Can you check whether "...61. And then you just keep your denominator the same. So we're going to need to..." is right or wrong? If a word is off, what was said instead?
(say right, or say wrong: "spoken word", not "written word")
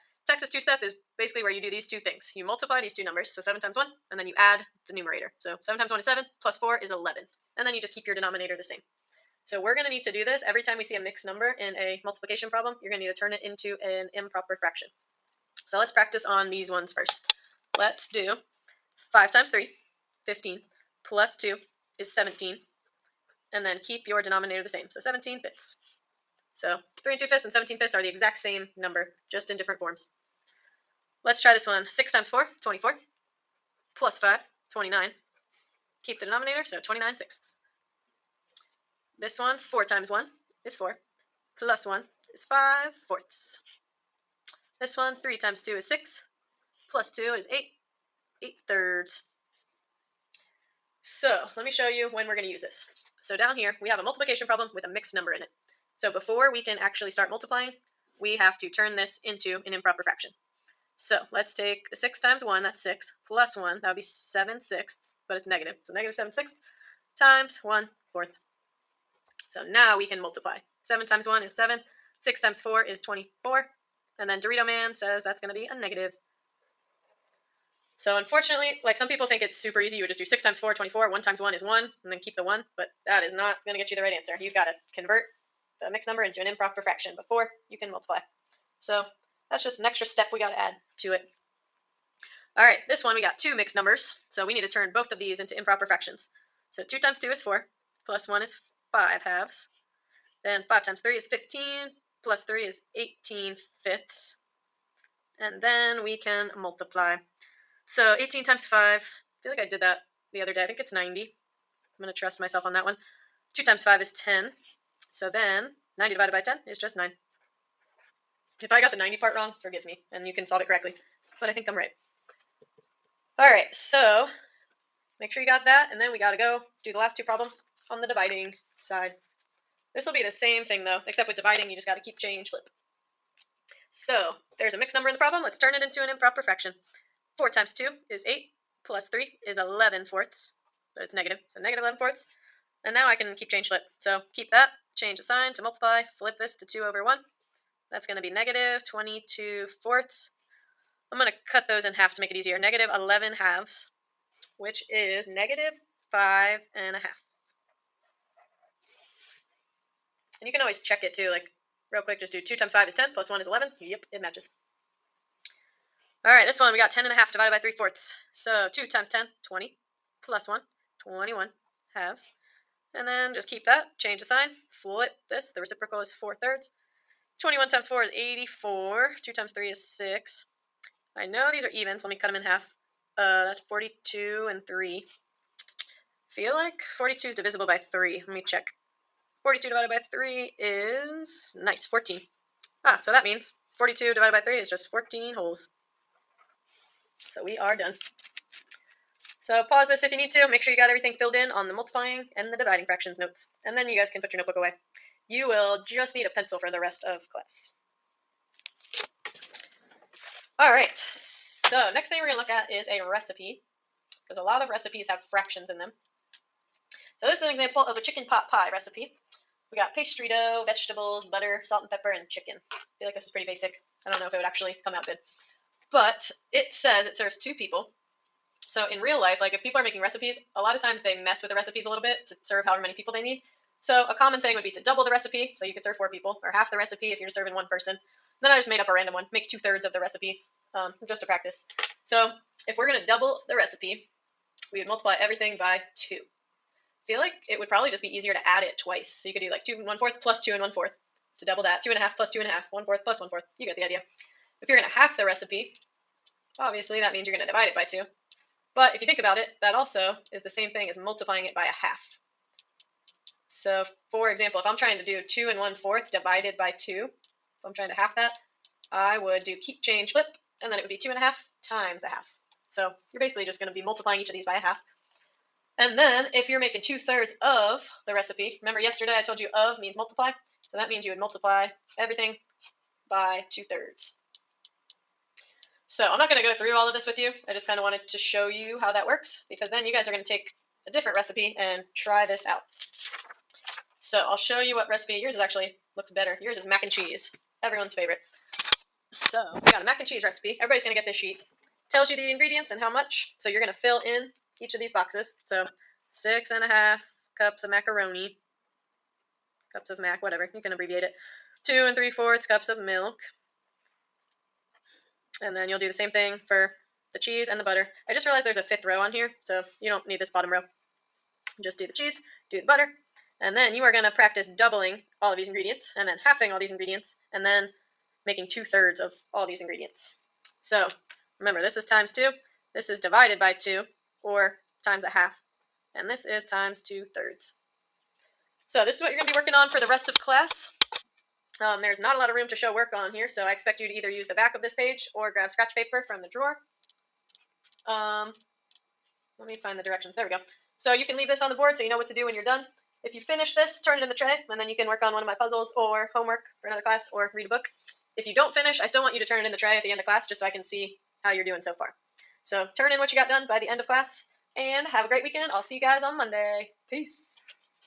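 wrong: "11", not "61".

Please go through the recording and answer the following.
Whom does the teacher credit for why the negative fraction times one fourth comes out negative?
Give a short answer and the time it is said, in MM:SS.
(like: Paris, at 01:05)
Dorito Man, at 01:14.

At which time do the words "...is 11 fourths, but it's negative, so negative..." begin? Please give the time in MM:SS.
02:19.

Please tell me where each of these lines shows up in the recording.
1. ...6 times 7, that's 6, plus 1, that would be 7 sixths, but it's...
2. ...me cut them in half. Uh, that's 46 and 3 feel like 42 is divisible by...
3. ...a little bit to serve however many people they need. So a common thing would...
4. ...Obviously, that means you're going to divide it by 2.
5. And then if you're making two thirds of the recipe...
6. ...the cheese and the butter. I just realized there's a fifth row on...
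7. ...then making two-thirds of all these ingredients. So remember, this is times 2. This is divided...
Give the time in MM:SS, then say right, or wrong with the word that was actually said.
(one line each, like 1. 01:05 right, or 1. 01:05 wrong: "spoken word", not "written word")
1. 01:01 wrong: "1", not "7"
2. 03:02 wrong: "42", not "46"
3. 03:51 right
4. 04:16 right
5. 04:35 right
6. 05:17 right
7. 05:27 right.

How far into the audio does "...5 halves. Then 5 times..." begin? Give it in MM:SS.
01:38.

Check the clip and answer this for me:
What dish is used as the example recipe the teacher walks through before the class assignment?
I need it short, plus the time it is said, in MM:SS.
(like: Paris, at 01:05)
chicken pot pie, at 03:38.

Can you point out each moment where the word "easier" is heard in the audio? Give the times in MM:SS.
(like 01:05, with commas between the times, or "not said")
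02:32, 04:08.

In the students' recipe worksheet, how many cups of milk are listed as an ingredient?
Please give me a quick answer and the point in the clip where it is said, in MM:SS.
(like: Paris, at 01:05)
2 3/4 cups, at 05:11.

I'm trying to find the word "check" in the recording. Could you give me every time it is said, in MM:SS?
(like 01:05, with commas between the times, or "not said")
02:40, 03:08.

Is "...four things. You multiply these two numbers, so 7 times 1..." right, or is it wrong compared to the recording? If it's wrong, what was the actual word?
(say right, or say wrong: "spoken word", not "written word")
wrong: "two", not "four".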